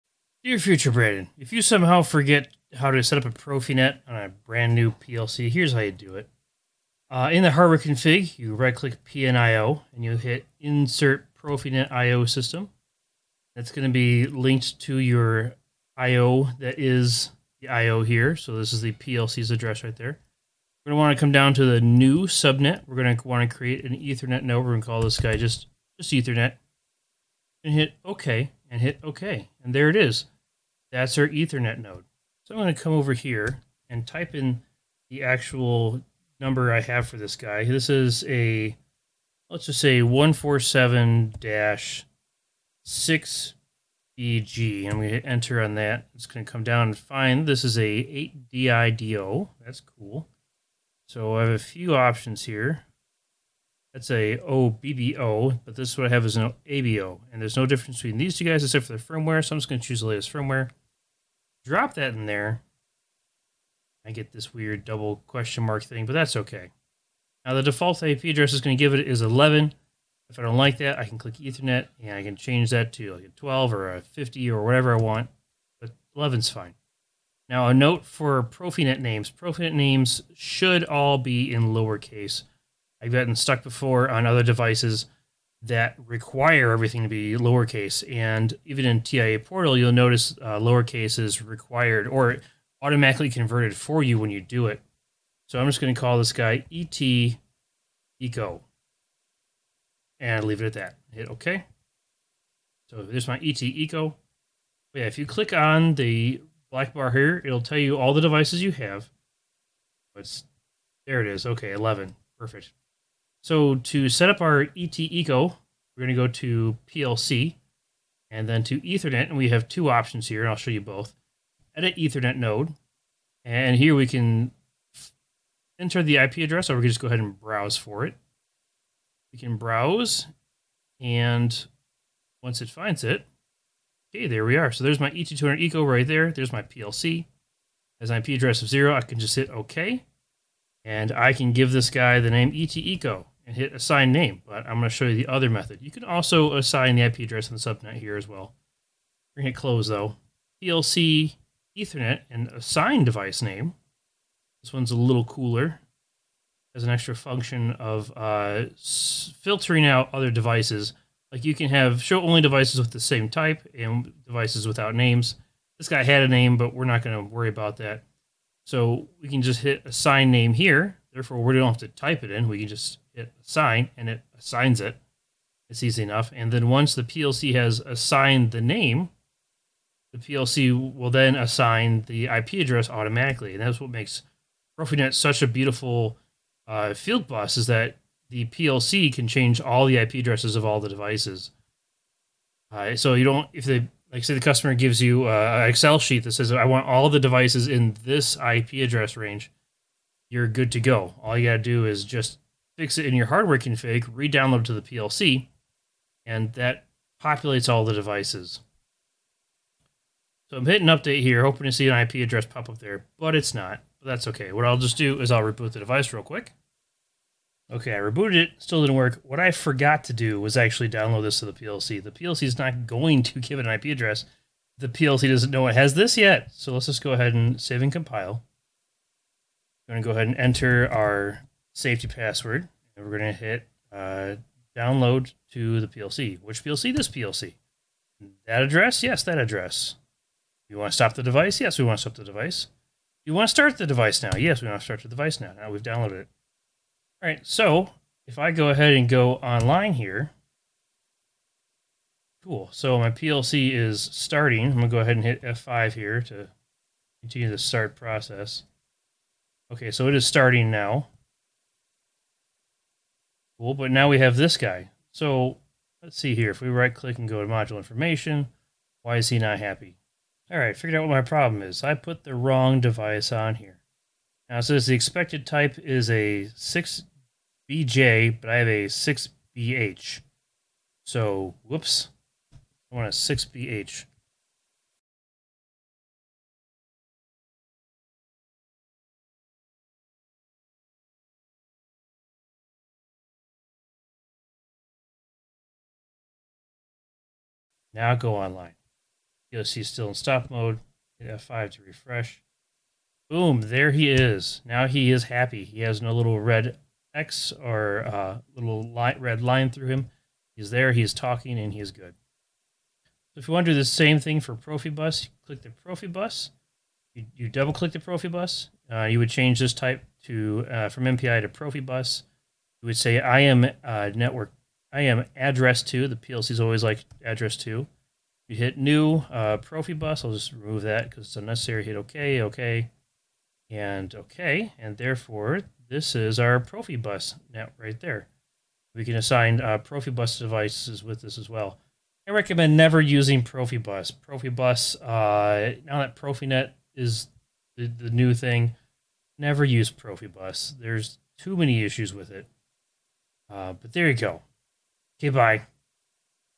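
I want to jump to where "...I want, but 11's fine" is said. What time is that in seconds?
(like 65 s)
74 s.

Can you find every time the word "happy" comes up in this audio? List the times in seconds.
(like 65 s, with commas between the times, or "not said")
269 s, 305 s.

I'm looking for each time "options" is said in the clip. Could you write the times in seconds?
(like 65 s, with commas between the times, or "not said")
51 s, 119 s.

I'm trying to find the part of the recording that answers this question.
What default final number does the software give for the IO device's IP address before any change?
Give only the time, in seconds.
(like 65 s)
69 s.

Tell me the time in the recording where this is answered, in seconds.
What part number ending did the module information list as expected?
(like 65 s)
276 s.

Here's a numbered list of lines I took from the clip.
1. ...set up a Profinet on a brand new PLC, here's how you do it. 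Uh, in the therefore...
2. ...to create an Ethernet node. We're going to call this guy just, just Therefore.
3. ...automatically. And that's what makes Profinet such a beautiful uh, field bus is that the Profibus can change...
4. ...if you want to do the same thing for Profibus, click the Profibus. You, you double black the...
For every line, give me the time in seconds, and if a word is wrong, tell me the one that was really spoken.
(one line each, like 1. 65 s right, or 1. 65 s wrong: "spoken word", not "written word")
1. 3 s wrong: "hardware", not "therefore"
2. 23 s wrong: "Ethernet", not "Therefore"
3. 182 s wrong: "PLC", not "Profibus"
4. 313 s wrong: "click", not "black".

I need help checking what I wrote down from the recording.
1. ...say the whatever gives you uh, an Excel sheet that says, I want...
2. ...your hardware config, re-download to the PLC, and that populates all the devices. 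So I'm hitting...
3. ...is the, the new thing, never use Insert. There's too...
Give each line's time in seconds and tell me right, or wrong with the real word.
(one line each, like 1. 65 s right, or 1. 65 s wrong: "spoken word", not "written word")
1. 194 s wrong: "customer", not "whatever"
2. 203 s right
3. 346 s wrong: "Profibus", not "Insert".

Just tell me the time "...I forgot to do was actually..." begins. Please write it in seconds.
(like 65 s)
219 s.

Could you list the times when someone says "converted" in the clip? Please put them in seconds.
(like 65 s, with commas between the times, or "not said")
93 s.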